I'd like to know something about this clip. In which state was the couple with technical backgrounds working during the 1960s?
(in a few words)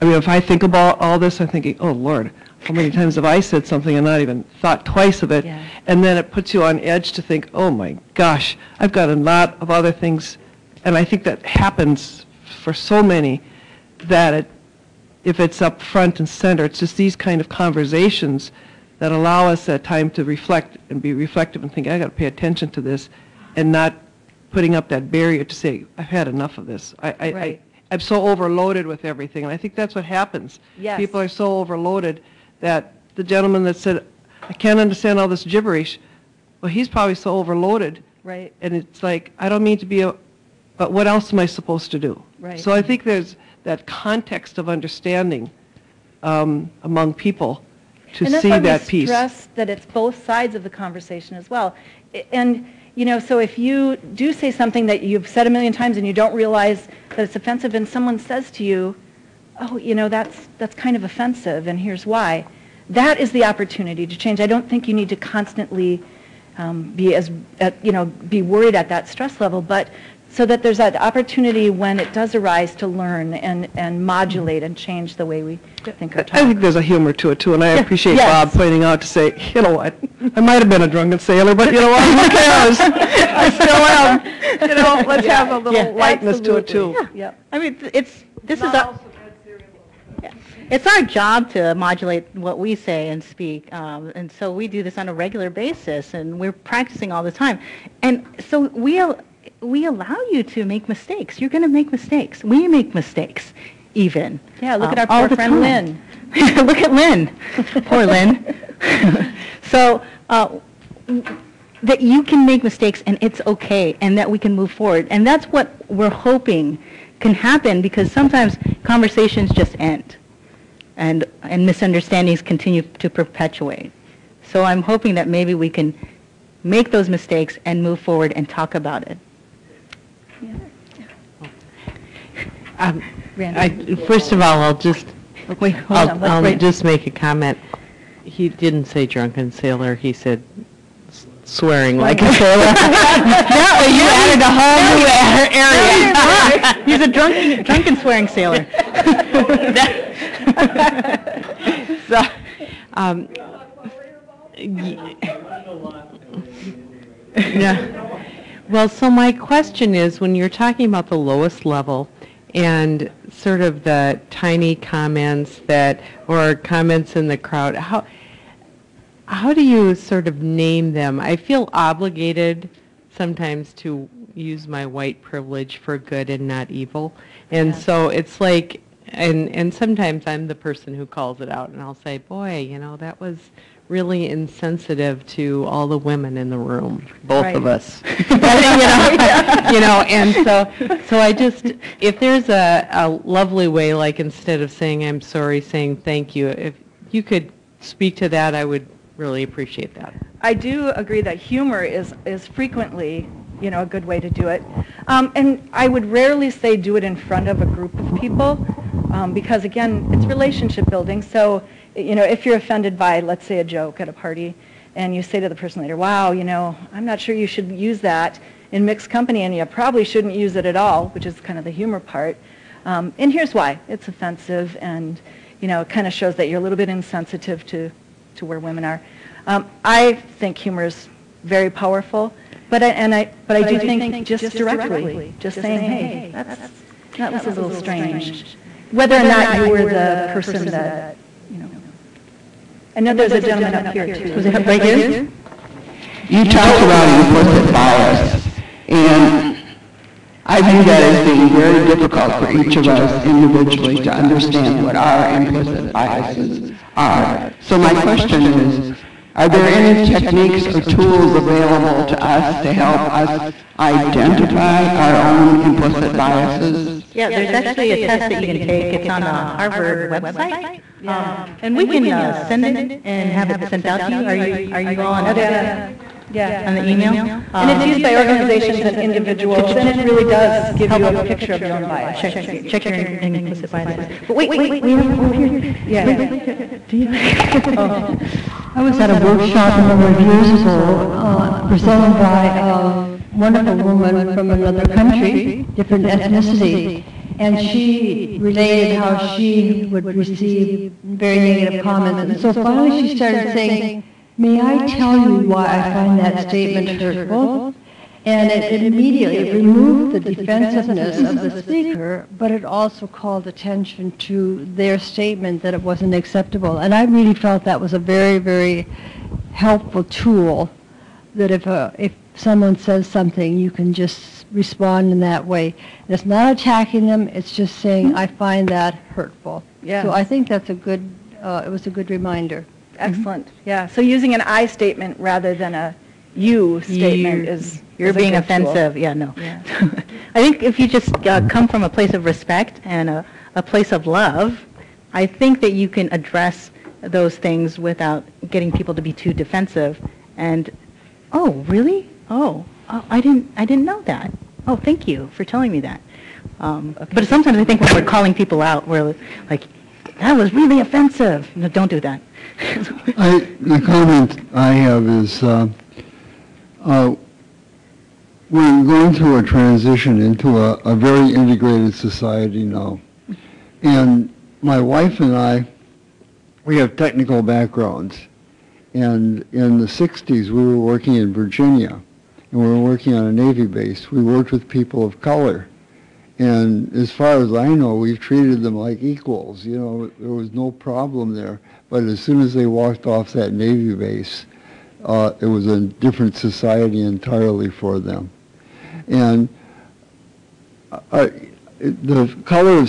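Virginia.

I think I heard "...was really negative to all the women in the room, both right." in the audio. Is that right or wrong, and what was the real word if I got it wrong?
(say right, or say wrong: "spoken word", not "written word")
wrong: "insensitive", not "negative".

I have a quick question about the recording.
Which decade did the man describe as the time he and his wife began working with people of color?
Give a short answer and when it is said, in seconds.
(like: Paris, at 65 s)
the 60s, at 379 s.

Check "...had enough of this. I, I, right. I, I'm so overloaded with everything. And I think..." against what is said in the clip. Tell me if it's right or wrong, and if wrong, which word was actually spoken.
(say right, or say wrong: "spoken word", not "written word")
right.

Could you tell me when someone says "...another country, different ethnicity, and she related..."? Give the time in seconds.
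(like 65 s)
294 s.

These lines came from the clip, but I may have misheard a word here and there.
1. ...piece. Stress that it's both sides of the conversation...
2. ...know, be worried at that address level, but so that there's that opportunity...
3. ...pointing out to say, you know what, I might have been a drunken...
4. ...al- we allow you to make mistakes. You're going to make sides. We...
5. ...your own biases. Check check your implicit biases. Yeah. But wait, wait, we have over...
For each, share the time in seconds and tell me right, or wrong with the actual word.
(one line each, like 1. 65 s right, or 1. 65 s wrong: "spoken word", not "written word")
1. 48 s right
2. 67 s wrong: "stress", not "address"
3. 78 s right
4. 98 s wrong: "mistakes", not "sides"
5. 281 s right.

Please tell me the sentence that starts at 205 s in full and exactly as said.
Um, and I would rarely say do it in front of a group of people um, because, again, it's relationship building.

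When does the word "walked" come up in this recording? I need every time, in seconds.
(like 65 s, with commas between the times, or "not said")
392 s.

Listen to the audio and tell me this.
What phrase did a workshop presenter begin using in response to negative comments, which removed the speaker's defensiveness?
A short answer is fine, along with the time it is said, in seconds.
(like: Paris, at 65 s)
May I tell you why I find that statement hurtful?, at 304 s.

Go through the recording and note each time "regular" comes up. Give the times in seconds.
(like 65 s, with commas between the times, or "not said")
95 s.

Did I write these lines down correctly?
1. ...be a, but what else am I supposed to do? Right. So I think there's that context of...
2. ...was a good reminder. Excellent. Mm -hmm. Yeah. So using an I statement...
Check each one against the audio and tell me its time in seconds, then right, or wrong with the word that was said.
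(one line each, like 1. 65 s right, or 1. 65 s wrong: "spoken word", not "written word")
1. 39 s right
2. 331 s right.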